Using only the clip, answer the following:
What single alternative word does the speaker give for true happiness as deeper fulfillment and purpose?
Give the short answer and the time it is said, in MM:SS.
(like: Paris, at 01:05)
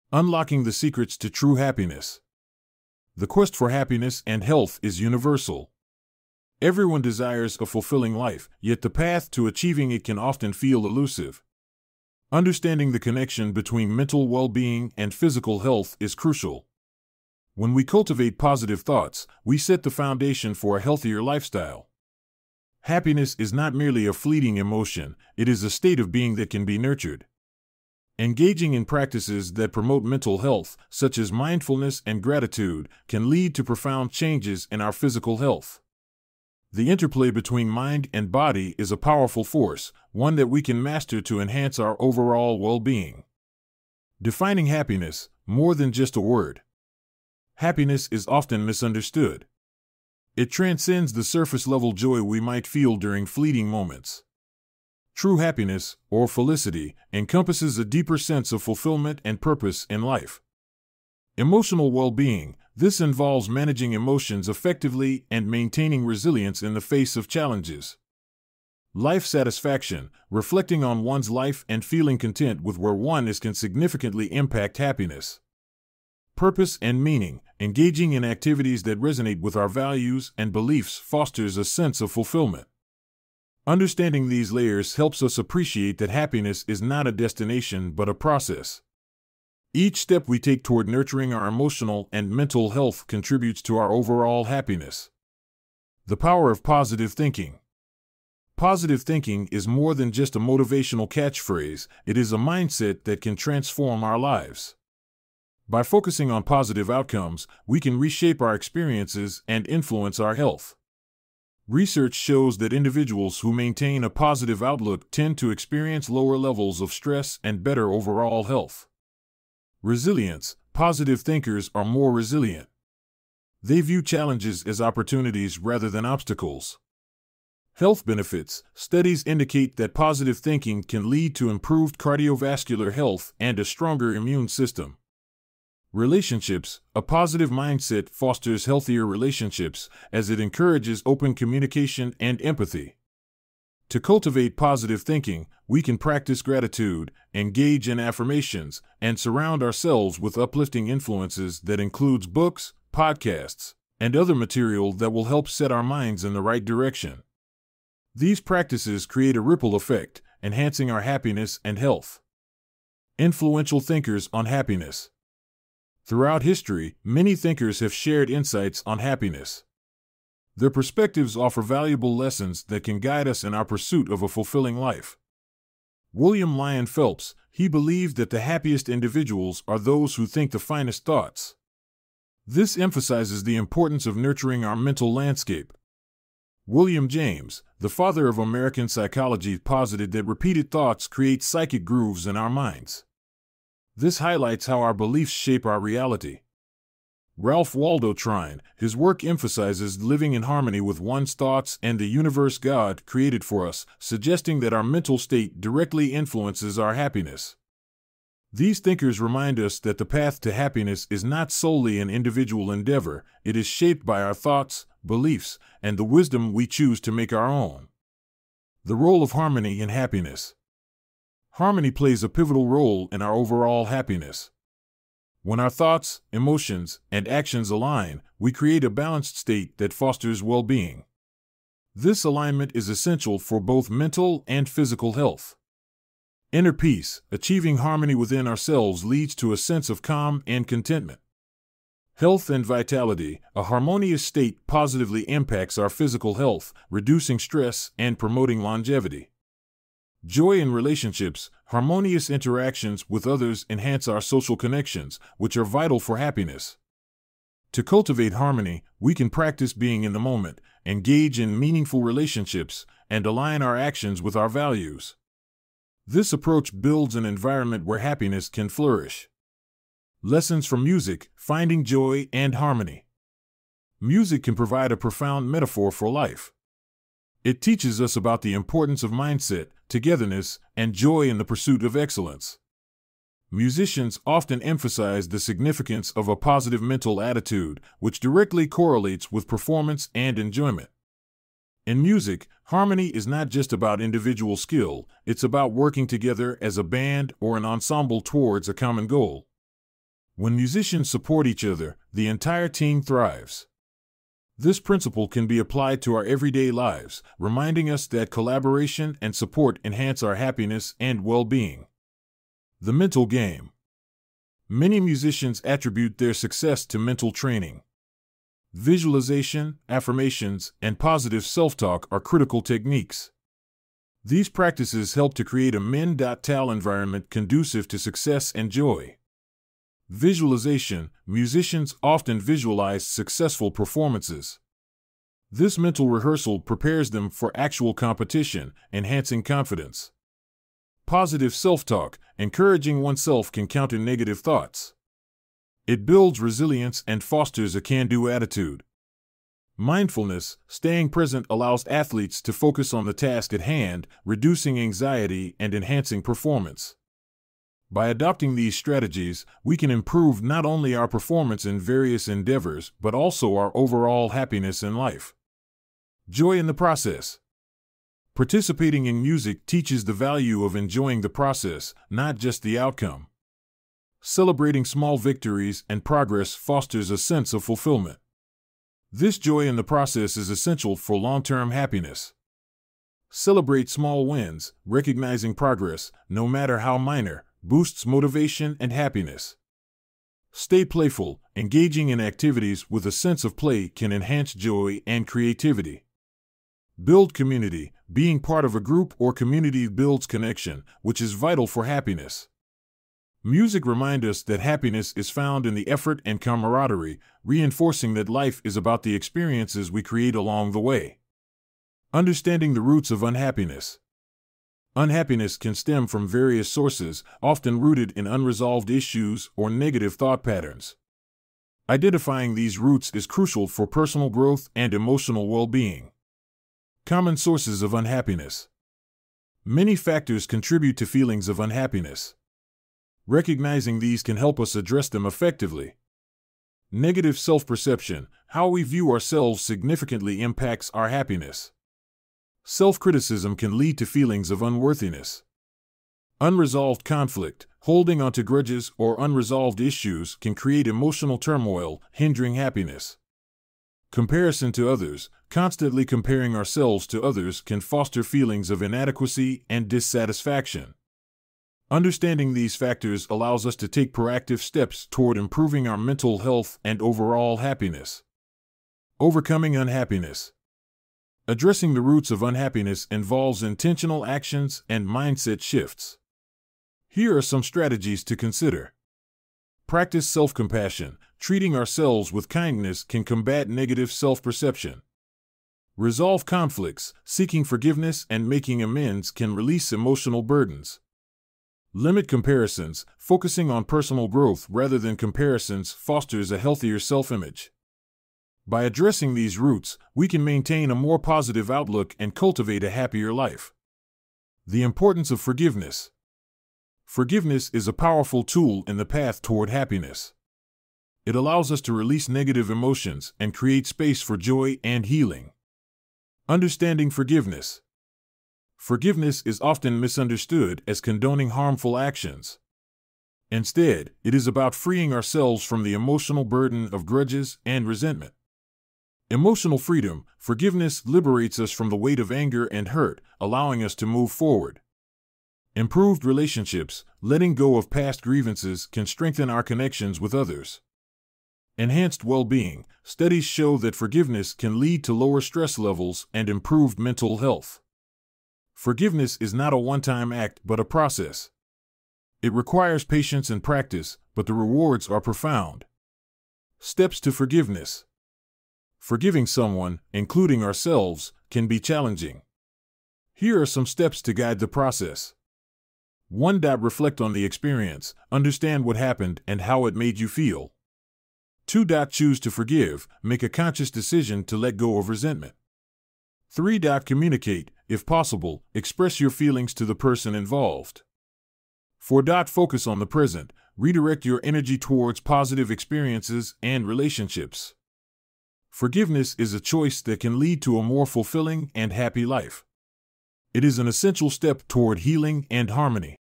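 felicity, at 00:56.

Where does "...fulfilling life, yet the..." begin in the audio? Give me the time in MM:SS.
00:07.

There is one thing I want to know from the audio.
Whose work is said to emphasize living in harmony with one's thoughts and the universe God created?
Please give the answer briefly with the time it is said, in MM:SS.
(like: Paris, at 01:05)
Ralph Waldo Trine, at 03:17.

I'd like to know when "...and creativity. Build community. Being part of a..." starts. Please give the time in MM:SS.
06:35.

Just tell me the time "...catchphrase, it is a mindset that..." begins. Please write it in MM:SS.
01:41.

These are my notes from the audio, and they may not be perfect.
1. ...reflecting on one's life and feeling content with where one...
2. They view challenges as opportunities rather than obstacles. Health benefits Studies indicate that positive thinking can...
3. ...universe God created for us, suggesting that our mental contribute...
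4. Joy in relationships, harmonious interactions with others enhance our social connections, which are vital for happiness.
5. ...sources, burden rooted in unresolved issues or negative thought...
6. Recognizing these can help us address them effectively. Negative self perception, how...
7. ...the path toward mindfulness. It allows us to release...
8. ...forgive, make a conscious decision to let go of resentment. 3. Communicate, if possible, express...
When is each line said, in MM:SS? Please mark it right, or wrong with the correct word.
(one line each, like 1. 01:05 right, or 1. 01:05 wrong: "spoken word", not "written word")
1. 01:10 right
2. 02:03 right
3. 03:22 wrong: "state", not "contribute"
4. 04:10 right
5. 06:56 wrong: "often", not "burden"
6. 07:13 right
7. 08:28 wrong: "happiness", not "mindfulness"
8. 09:32 right.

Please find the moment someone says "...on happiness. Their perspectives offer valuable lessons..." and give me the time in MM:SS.
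02:48.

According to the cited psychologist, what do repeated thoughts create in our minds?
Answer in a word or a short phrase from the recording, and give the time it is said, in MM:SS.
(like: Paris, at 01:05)
psychic grooves, at 03:11.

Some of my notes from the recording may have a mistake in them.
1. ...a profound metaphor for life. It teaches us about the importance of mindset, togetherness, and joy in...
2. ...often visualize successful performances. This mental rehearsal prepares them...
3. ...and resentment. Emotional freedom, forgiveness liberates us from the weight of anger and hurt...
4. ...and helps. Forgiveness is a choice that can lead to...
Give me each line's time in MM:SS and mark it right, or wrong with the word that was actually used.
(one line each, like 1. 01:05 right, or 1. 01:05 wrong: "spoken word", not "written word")
1. 04:34 right
2. 05:32 right
3. 08:47 right
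4. 09:46 wrong: "relationships", not "helps".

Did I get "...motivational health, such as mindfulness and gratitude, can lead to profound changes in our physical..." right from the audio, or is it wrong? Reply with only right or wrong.
wrong.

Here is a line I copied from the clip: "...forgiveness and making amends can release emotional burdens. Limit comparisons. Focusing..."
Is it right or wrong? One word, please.
right.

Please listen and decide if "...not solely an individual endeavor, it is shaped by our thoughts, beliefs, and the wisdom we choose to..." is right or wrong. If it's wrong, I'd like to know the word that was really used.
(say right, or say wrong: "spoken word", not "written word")
right.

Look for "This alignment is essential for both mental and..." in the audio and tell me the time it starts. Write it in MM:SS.
03:51.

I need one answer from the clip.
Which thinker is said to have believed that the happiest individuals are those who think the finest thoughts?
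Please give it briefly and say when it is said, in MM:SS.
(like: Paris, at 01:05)
William Lyon Phelps, at 02:56.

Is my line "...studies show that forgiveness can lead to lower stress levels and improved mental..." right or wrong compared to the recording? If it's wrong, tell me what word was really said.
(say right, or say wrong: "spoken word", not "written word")
right.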